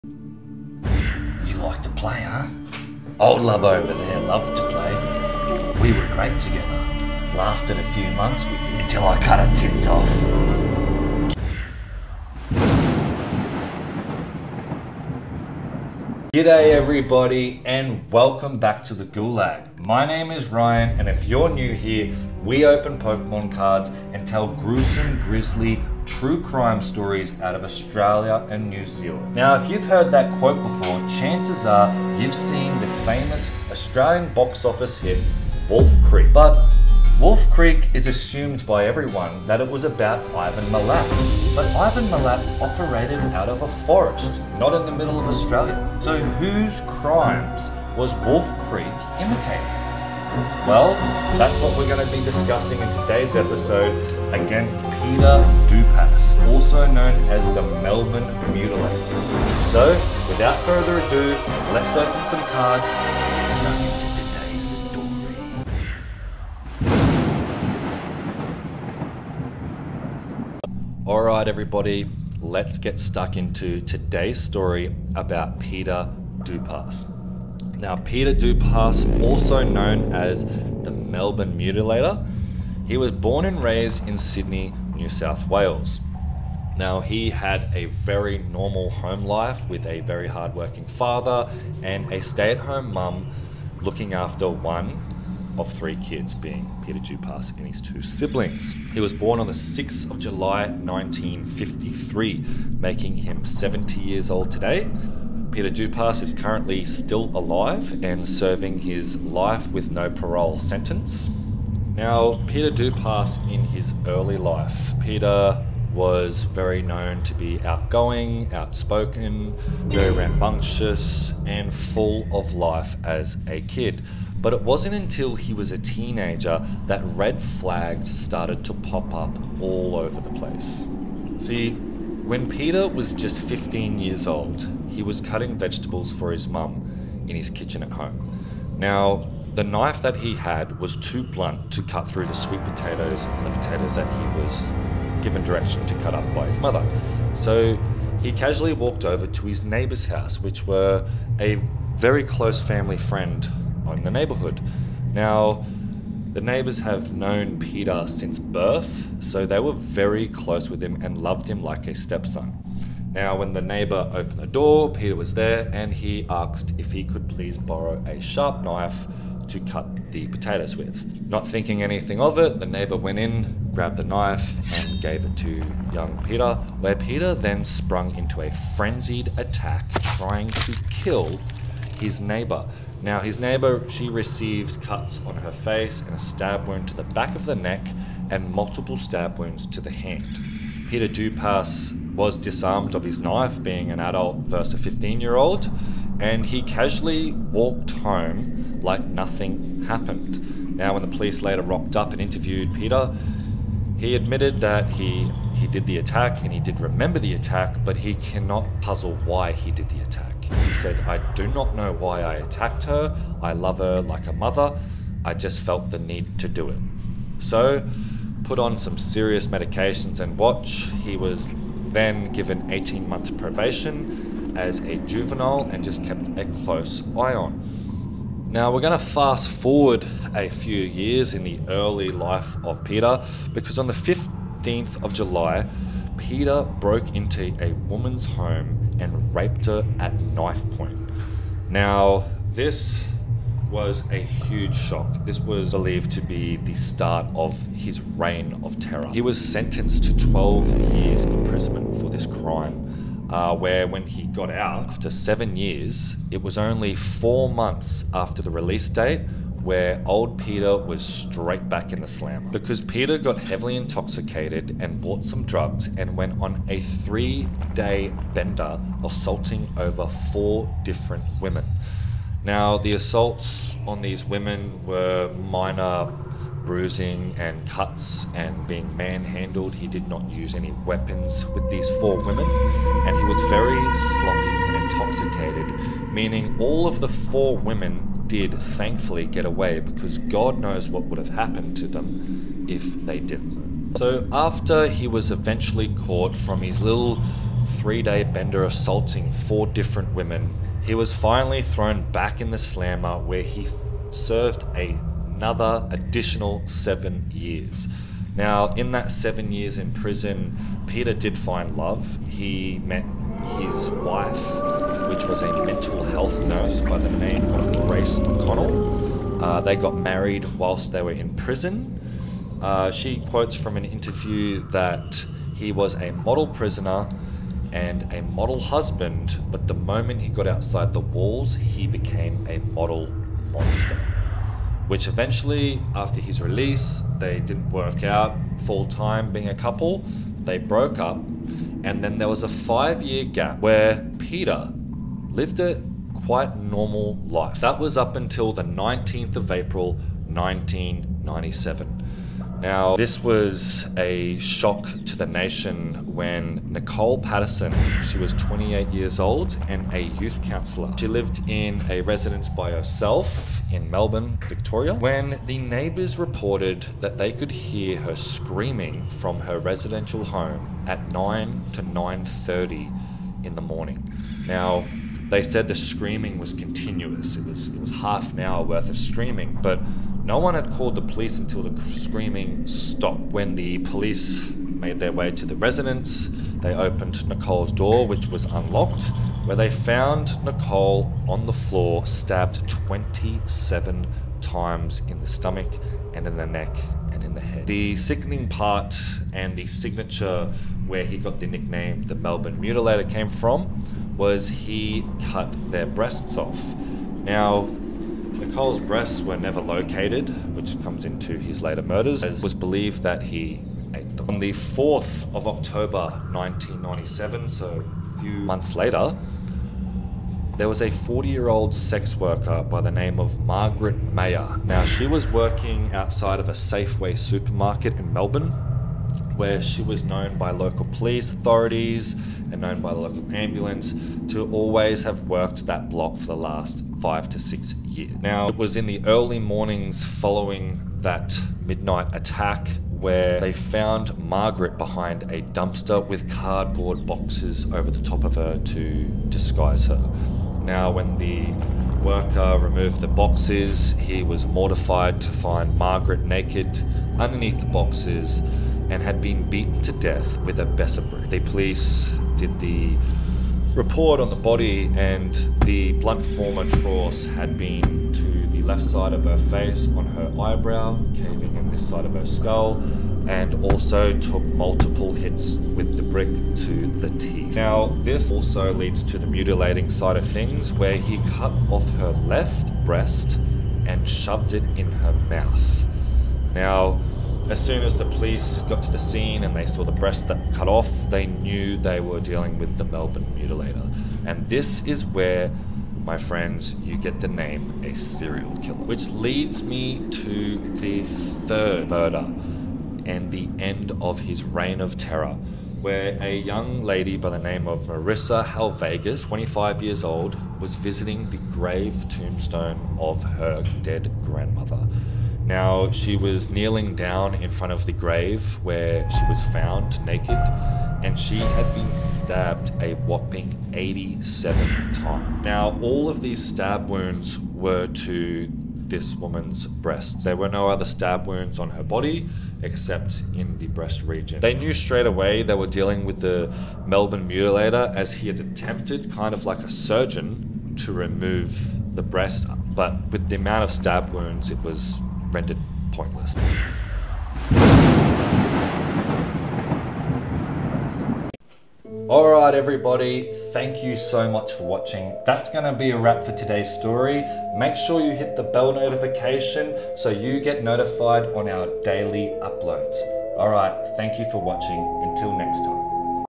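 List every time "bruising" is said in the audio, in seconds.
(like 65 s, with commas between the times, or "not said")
276 s.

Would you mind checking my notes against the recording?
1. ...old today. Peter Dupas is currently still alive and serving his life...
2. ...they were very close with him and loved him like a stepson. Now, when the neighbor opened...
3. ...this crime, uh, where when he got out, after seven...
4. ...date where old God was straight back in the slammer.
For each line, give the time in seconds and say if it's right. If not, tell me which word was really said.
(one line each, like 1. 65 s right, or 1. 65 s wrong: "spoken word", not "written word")
1. 104 s right
2. 159 s right
3. 252 s right
4. 258 s wrong: "Peter", not "God".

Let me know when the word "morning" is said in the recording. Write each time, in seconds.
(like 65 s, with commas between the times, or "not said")
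373 s, 439 s.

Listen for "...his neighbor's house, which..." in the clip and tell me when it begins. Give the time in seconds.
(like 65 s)
149 s.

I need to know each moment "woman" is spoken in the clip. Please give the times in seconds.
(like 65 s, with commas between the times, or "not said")
237 s, 529 s.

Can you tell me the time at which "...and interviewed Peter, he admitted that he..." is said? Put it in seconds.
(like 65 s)
202 s.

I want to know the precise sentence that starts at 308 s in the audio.
Now, in that seven years in prison, Peter did find love.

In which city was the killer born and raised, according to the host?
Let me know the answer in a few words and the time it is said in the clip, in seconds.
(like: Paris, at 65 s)
Sydney, at 84 s.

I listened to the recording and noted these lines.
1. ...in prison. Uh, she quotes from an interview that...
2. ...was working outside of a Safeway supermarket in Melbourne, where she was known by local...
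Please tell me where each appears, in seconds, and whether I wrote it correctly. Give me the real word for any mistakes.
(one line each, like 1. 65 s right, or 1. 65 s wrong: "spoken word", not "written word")
1. 321 s right
2. 425 s right.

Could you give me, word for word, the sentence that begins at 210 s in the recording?
He said, I do not know why I attacked her.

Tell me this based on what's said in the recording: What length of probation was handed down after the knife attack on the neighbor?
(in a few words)
18 months.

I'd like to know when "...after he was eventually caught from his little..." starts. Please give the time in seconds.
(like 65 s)
294 s.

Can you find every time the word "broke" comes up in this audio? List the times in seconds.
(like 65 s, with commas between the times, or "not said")
236 s, 340 s.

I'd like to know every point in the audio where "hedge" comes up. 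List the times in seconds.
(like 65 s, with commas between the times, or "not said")
not said.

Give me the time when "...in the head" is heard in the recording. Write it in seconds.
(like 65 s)
397 s.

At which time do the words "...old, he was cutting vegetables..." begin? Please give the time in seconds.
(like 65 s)
134 s.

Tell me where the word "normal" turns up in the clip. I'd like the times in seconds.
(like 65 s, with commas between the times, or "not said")
88 s, 346 s.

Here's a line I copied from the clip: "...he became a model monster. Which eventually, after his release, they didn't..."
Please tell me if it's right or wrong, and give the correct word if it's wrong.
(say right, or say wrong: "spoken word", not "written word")
right.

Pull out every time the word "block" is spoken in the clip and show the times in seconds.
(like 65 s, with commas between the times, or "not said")
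435 s.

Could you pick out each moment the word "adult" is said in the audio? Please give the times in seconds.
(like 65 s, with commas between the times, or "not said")
194 s.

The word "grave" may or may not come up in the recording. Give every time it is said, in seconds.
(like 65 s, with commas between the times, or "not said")
511 s, 517 s.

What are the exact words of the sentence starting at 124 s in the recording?
But it wasn't until he was a teenager that red flags started to pop up all over the place.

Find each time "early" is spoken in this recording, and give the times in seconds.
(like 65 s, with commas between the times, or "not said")
114 s, 231 s, 439 s.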